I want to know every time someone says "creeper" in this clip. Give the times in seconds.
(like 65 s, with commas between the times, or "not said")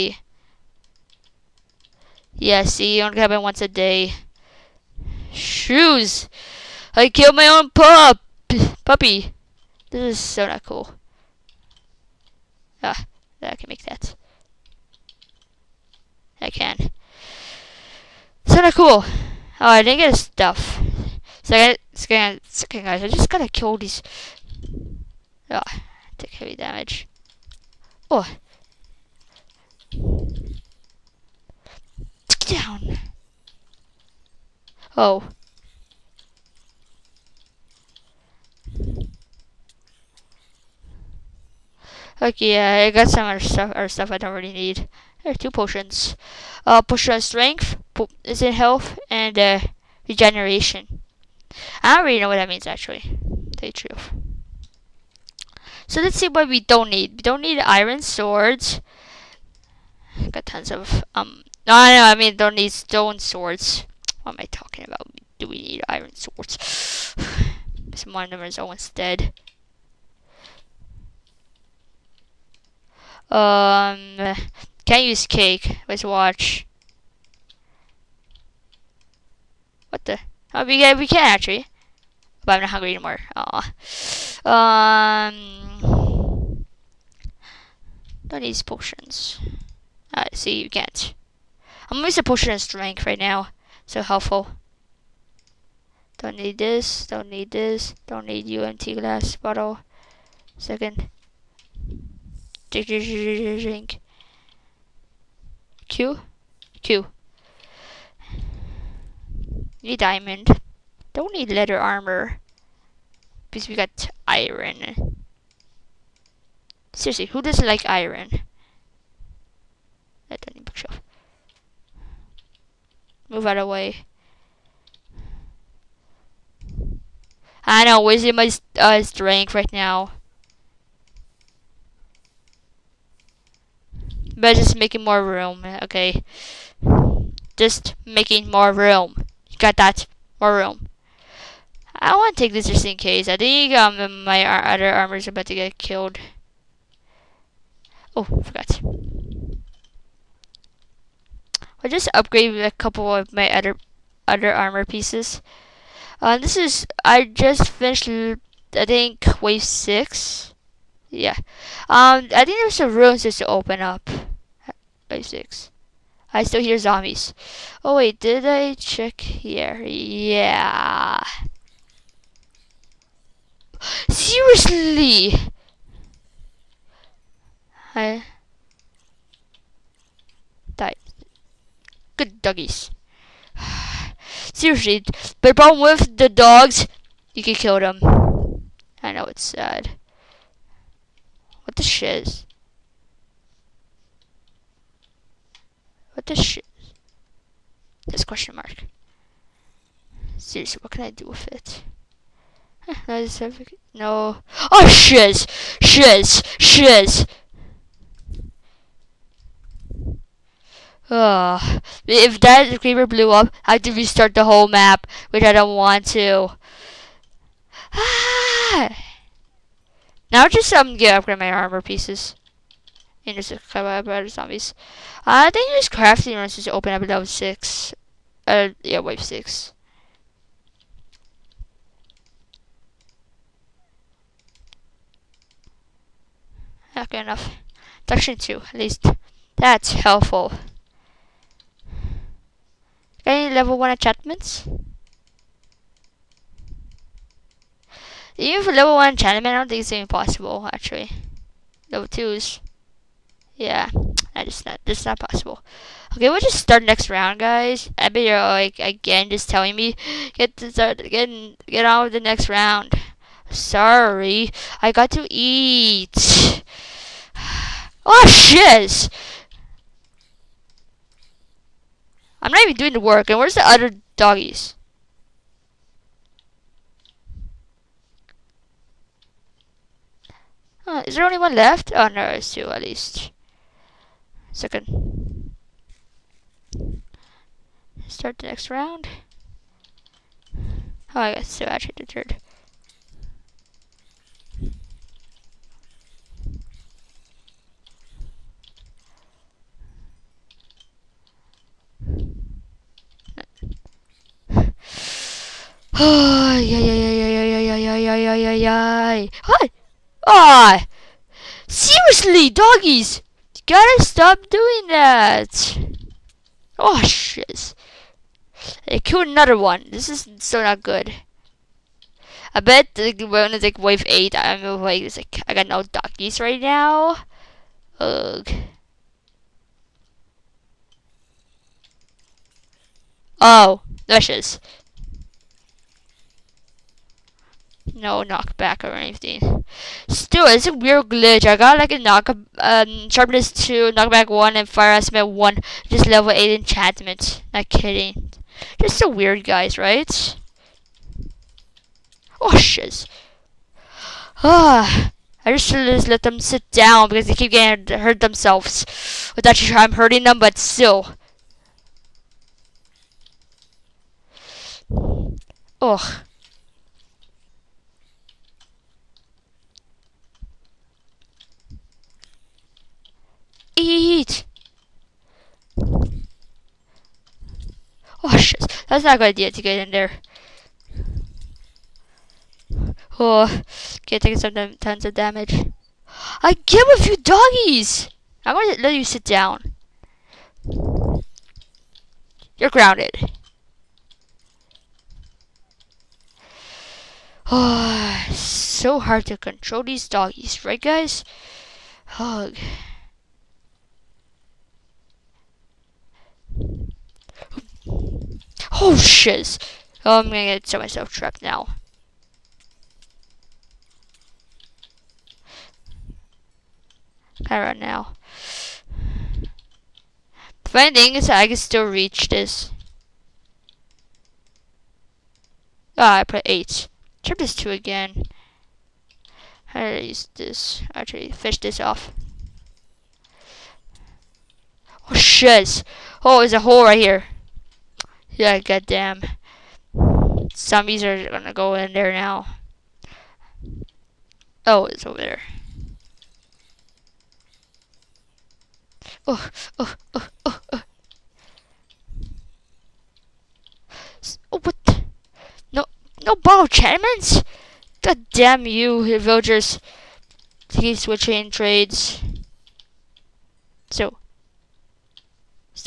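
212 s.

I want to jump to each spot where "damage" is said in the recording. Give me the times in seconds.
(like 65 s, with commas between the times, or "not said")
26 s, 385 s.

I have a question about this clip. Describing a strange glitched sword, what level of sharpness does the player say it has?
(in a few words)
2.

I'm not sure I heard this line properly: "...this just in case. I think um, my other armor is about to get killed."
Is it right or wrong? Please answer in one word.
right.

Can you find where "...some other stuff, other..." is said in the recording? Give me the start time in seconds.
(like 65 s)
43 s.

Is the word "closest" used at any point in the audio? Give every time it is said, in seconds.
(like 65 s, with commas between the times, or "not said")
not said.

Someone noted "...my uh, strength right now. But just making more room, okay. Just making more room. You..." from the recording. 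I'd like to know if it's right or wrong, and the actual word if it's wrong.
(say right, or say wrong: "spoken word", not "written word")
right.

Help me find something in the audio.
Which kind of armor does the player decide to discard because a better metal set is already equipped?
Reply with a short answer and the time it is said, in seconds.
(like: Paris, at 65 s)
Leather armor, at 111 s.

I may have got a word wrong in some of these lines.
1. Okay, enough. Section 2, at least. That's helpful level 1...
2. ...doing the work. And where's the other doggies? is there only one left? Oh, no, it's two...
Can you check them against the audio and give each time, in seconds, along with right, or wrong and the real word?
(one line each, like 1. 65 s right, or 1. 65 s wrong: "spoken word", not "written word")
1. 236 s right
2. 272 s right.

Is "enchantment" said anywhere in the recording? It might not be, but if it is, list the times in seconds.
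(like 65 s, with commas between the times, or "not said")
243 s, 249 s, 346 s.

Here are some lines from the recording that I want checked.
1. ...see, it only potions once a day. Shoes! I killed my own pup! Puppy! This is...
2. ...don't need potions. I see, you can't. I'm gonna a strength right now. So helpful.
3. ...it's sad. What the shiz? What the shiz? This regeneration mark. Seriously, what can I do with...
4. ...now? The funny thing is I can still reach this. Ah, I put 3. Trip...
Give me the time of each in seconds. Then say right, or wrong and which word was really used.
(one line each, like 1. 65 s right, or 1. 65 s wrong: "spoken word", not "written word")
1. 2 s wrong: "happens", not "potions"
2. 88 s right
3. 189 s wrong: "question", not "regeneration"
4. 417 s wrong: "8", not "3".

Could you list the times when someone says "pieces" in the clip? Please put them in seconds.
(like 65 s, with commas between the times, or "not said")
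154 s, 221 s.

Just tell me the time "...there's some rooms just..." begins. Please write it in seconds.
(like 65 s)
162 s.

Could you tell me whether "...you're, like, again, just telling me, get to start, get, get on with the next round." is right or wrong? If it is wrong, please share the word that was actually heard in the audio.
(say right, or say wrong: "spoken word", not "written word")
right.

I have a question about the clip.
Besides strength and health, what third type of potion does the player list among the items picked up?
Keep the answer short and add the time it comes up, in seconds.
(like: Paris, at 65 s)
Regeneration, at 50 s.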